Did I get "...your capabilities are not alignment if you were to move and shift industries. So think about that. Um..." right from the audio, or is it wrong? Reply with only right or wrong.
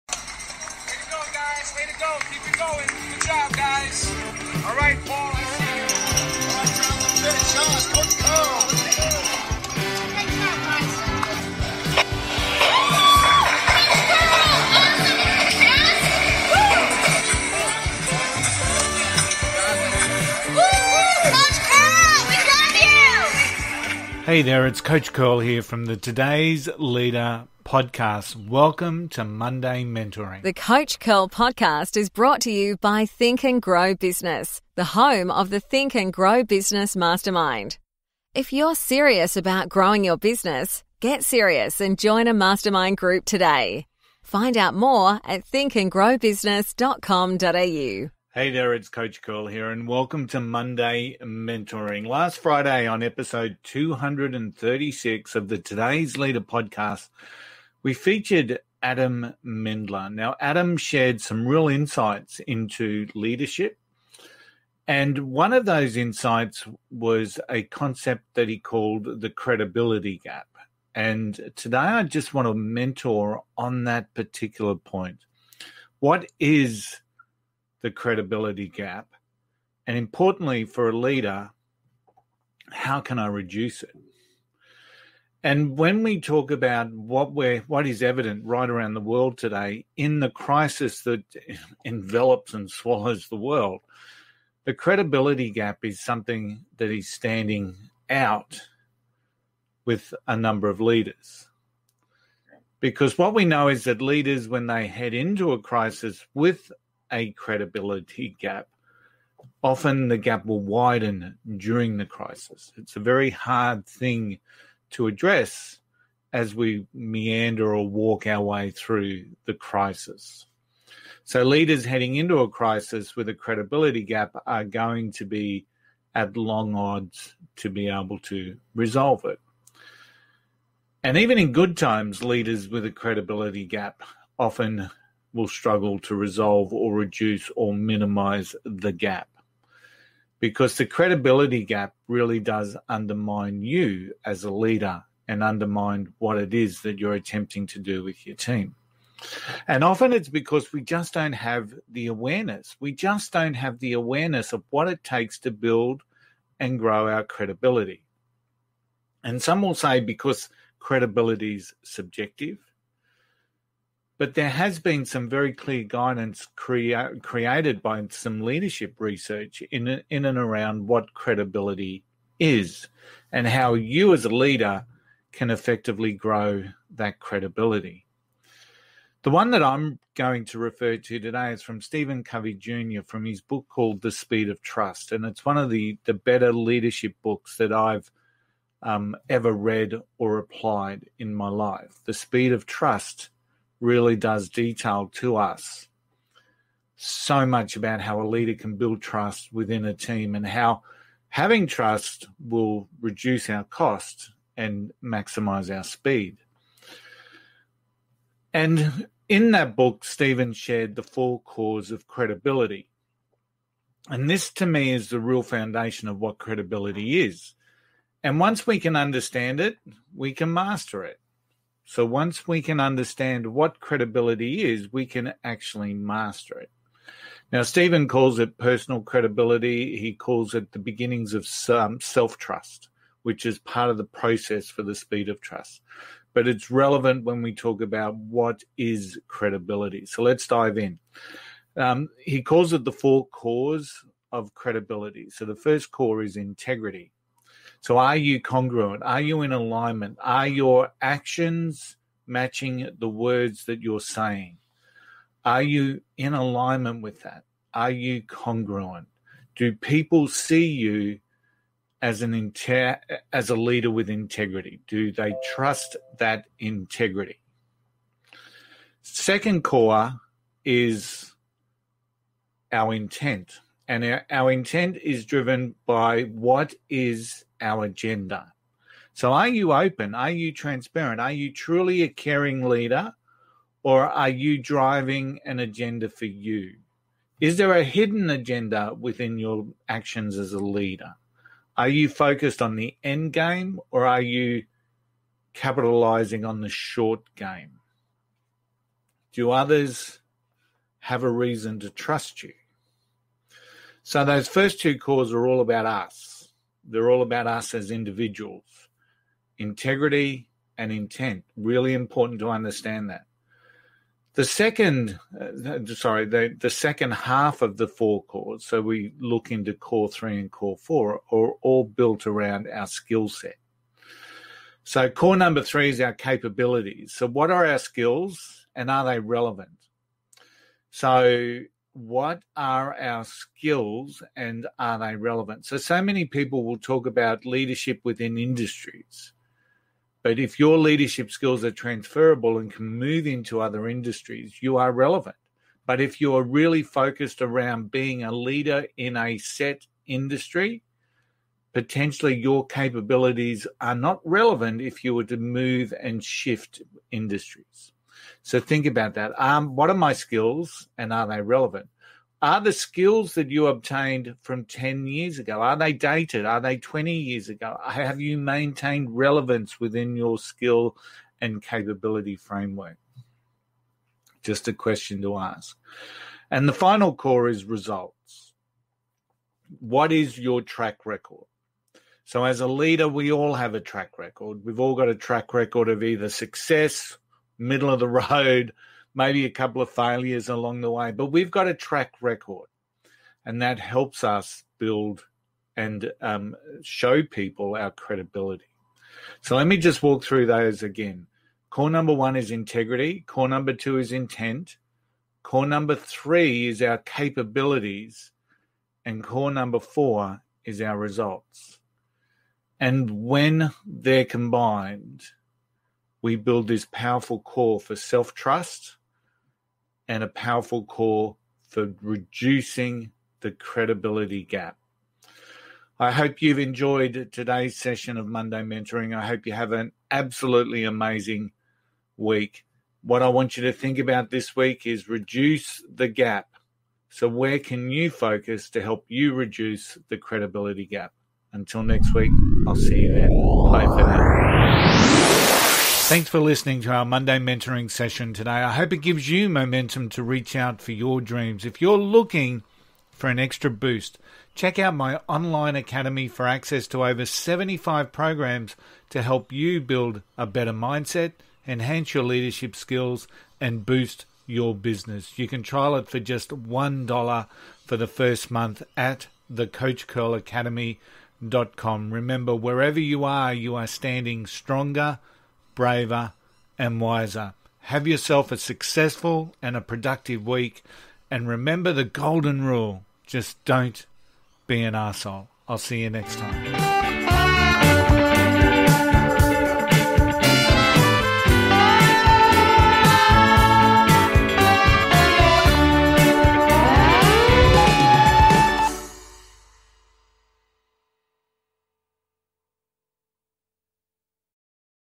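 wrong.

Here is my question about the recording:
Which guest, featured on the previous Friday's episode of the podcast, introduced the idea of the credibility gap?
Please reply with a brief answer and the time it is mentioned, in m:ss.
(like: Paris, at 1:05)
Adam Mendler, at 0:58.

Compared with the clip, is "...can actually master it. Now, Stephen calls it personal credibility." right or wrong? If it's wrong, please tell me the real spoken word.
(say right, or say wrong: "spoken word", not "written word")
right.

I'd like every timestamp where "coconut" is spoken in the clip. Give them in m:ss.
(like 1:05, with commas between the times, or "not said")
not said.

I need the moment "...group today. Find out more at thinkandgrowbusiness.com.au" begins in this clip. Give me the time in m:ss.
0:42.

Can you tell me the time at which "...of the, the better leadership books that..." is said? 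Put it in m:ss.
3:05.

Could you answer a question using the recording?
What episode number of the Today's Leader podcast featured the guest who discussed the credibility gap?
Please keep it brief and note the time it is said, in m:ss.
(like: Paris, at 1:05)
236, at 0:53.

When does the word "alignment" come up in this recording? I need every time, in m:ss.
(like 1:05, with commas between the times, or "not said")
4:09, 4:16.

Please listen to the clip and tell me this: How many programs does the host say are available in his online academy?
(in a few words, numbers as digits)
Over 75.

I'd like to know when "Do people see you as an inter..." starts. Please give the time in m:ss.
4:19.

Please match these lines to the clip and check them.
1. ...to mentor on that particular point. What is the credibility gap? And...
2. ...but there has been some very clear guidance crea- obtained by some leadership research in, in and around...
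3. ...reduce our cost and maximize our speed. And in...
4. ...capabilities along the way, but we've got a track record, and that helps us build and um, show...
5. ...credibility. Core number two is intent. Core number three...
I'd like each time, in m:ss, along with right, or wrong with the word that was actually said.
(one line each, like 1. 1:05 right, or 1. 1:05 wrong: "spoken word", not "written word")
1. 1:12 right
2. 2:44 wrong: "created", not "obtained"
3. 3:23 right
4. 6:29 wrong: "failures", not "capabilities"
5. 6:42 wrong: "integrity", not "credibility".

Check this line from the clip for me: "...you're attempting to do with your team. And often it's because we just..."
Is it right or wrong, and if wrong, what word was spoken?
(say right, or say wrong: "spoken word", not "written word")
right.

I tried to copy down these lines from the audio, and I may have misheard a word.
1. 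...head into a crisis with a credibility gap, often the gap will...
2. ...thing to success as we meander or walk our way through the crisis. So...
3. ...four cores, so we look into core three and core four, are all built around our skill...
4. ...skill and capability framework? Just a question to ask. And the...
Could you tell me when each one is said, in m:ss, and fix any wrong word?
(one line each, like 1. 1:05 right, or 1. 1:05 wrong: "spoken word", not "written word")
1. 1:44 right
2. 1:53 wrong: "address", not "success"
3. 5:17 right
4. 6:10 right.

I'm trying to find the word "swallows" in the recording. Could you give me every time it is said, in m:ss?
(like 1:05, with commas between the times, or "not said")
1:32.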